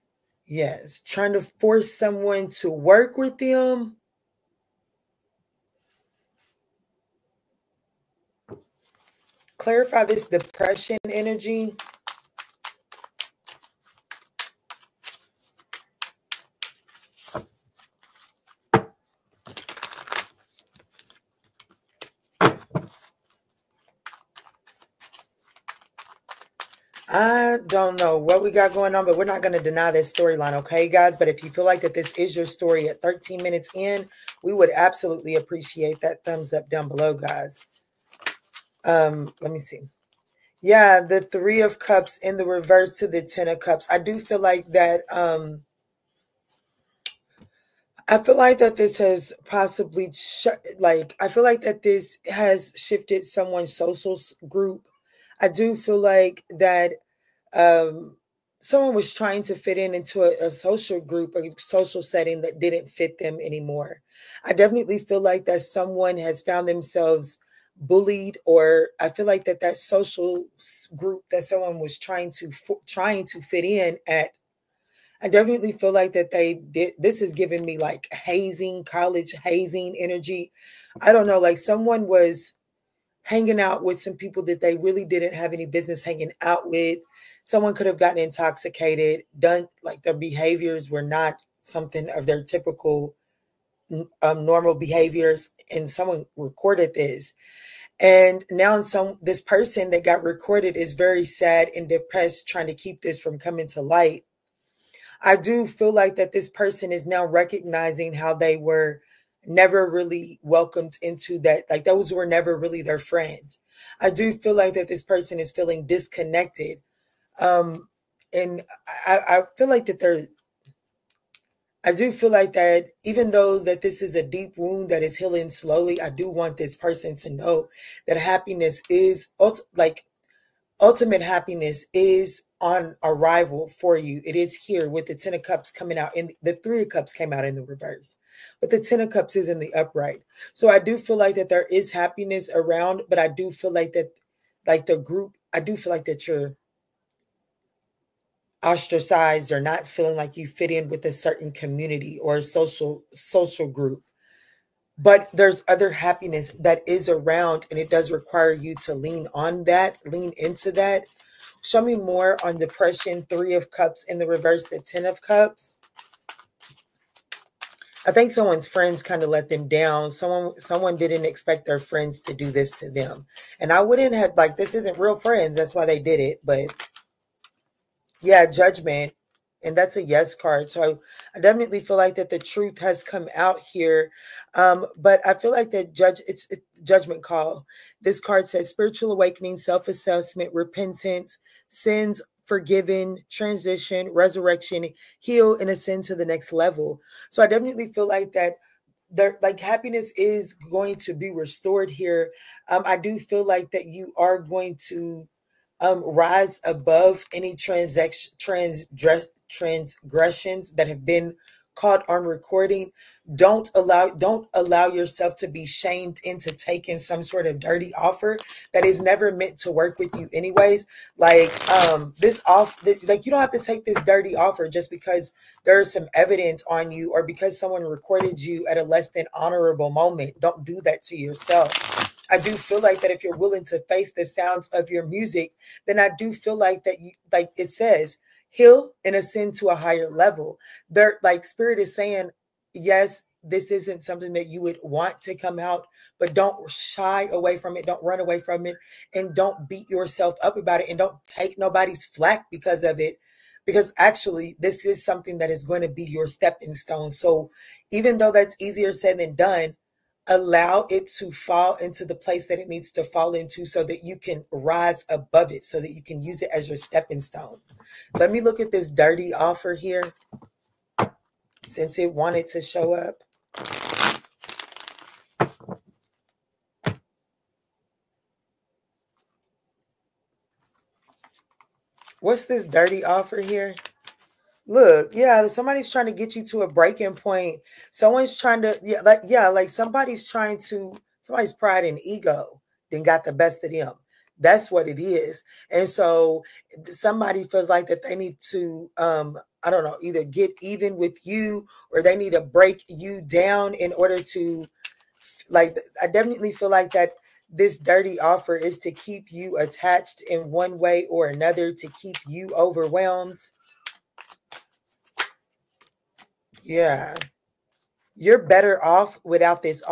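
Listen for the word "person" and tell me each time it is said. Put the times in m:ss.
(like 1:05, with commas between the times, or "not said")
1:39, 1:46, 1:55, 2:06.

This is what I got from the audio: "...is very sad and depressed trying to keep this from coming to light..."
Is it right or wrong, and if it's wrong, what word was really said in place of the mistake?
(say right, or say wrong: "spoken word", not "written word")
right.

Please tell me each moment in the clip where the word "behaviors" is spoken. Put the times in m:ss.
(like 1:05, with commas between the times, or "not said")
1:30, 1:34.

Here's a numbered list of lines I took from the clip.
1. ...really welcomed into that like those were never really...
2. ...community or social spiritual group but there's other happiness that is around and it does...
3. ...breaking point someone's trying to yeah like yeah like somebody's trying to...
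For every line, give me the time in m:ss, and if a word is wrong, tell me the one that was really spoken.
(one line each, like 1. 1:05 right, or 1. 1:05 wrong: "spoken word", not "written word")
1. 1:49 right
2. 2:31 wrong: "social", not "spiritual"
3. 4:46 right.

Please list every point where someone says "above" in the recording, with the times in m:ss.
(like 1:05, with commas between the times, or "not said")
3:26, 4:25.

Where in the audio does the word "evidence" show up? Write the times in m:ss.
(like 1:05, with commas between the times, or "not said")
3:46.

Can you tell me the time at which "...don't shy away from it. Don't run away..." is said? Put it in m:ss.
4:06.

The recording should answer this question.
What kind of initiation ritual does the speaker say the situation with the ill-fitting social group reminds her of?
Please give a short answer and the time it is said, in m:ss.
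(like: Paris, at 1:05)
college hazing, at 1:18.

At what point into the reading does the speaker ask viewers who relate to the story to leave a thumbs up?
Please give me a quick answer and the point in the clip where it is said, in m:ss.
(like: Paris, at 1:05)
13 minutes, at 0:33.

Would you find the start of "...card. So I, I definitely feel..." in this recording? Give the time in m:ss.
3:00.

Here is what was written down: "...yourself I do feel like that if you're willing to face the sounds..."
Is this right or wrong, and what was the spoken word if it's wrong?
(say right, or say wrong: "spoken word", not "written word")
right.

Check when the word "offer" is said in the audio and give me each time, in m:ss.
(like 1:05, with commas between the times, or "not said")
3:37, 3:44, 4:29, 4:43, 5:08.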